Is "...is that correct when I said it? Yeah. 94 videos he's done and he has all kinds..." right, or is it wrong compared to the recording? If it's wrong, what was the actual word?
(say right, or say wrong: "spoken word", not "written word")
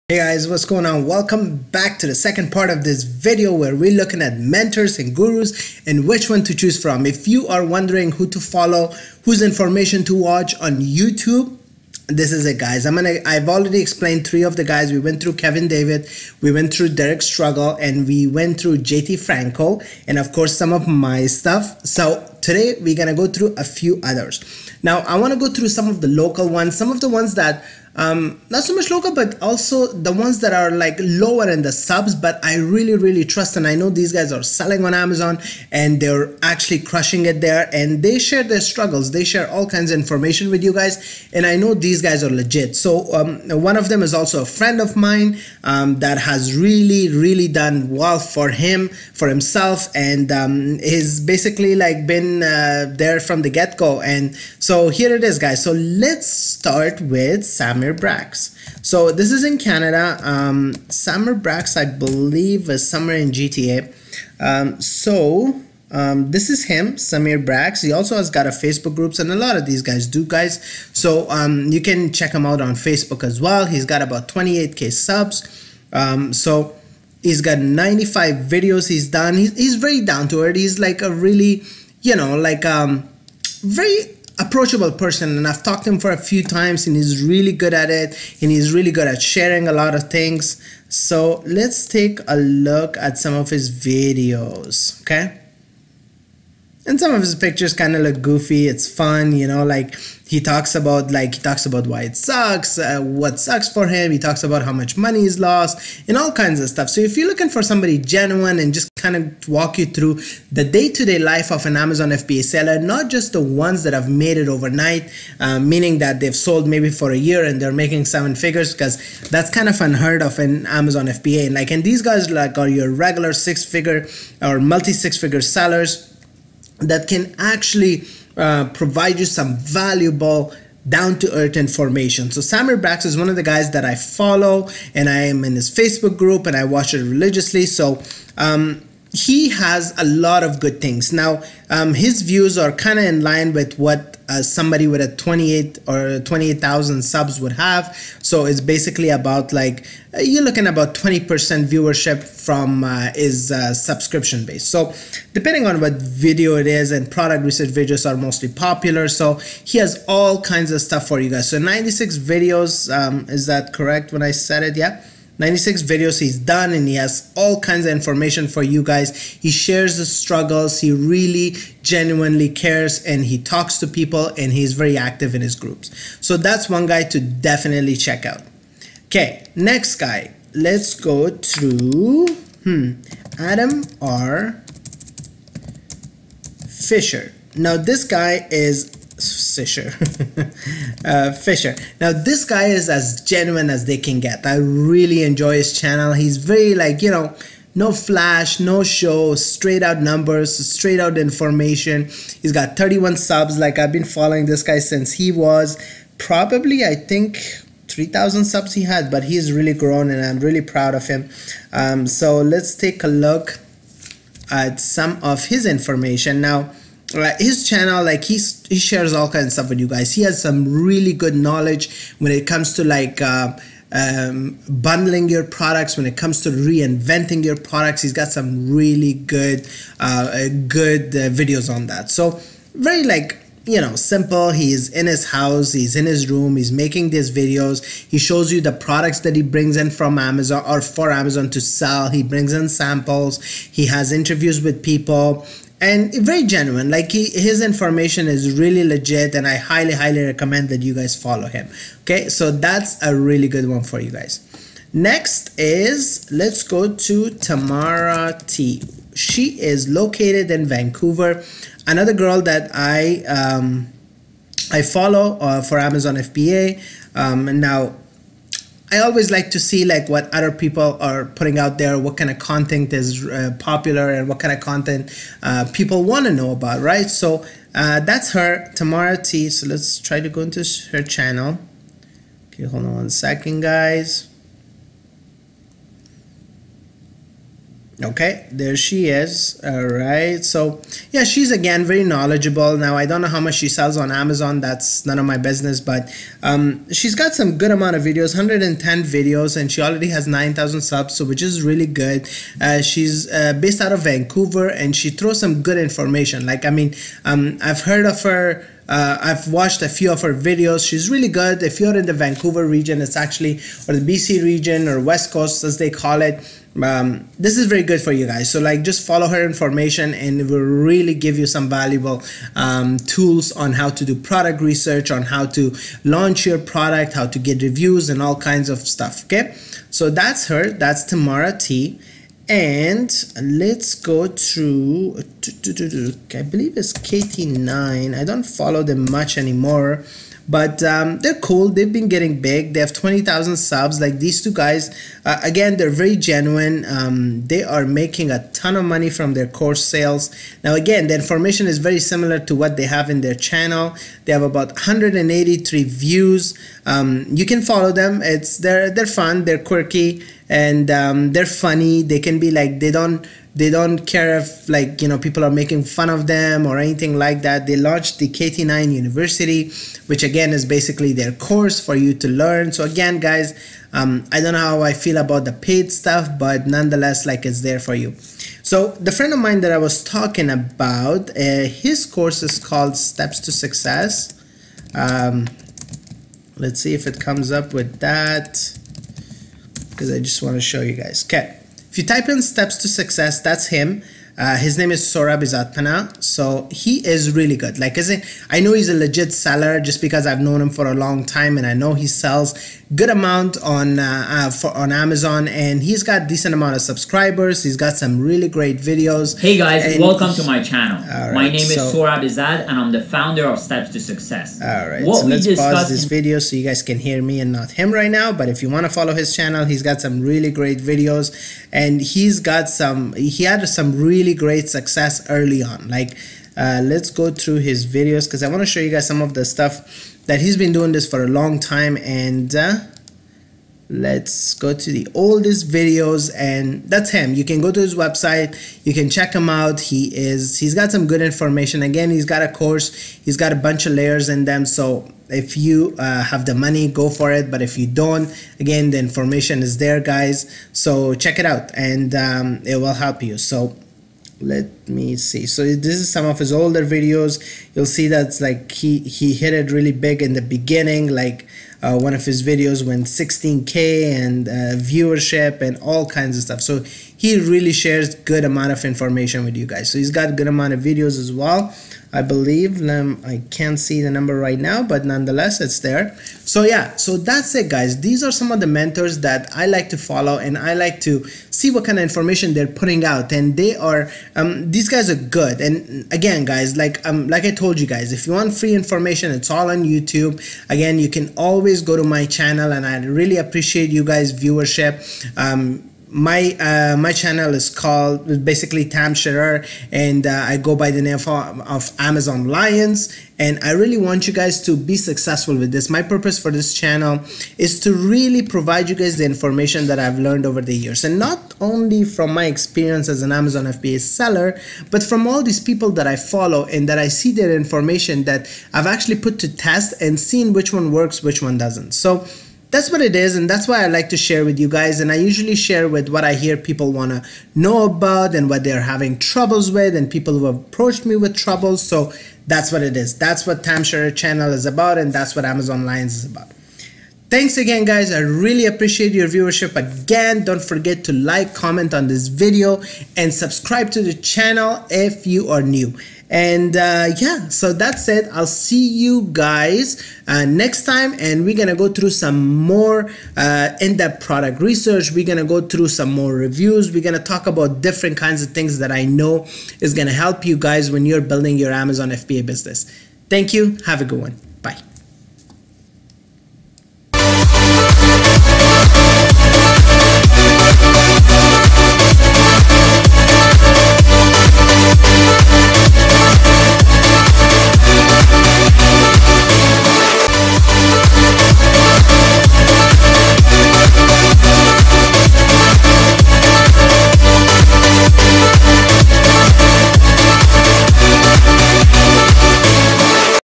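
wrong: "96", not "94".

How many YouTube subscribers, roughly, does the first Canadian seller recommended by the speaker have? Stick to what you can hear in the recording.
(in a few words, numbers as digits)
28k.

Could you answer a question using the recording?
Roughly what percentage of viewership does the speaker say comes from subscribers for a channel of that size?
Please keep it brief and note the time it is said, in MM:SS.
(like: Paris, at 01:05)
20%, at 02:30.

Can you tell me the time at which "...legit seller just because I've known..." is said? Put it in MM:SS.
06:38.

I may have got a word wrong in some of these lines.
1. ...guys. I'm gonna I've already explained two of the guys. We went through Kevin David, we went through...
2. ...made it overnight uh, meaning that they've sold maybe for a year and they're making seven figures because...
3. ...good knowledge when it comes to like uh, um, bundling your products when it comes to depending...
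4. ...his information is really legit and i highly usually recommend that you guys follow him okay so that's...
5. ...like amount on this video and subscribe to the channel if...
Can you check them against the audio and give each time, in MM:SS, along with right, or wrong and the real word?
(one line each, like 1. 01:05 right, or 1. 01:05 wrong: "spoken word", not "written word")
1. 00:12 wrong: "three", not "two"
2. 01:54 right
3. 03:41 wrong: "reinventing", not "depending"
4. 04:07 wrong: "highly", not "usually"
5. 09:01 wrong: "comment", not "amount".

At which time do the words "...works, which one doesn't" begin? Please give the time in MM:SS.
08:40.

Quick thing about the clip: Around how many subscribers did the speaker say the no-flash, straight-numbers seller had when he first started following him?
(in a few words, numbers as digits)
3,000.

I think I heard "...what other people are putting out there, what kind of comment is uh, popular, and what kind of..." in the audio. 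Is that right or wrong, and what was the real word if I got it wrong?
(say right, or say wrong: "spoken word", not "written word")
wrong: "content", not "comment".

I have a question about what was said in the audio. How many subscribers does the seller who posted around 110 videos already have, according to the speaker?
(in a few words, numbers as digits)
9000.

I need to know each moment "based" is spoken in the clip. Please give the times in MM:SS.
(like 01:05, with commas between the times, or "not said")
02:34, 05:03.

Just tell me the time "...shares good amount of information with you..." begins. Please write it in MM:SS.
07:47.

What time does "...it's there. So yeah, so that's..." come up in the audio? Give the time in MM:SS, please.
07:55.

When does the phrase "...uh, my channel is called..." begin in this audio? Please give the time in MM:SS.
08:16.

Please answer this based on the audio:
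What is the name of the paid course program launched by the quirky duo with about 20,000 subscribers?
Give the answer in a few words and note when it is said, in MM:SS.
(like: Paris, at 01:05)
KT9 University, at 06:08.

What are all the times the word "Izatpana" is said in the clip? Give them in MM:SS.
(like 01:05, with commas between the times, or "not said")
06:35.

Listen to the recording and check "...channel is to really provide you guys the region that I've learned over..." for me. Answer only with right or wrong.
wrong.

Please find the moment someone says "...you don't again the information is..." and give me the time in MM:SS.
07:27.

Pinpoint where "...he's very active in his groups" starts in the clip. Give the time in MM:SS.
02:54.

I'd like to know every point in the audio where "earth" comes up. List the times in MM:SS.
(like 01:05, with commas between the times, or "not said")
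01:20, 02:11.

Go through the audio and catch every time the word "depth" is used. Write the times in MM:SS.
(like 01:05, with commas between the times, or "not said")
09:13.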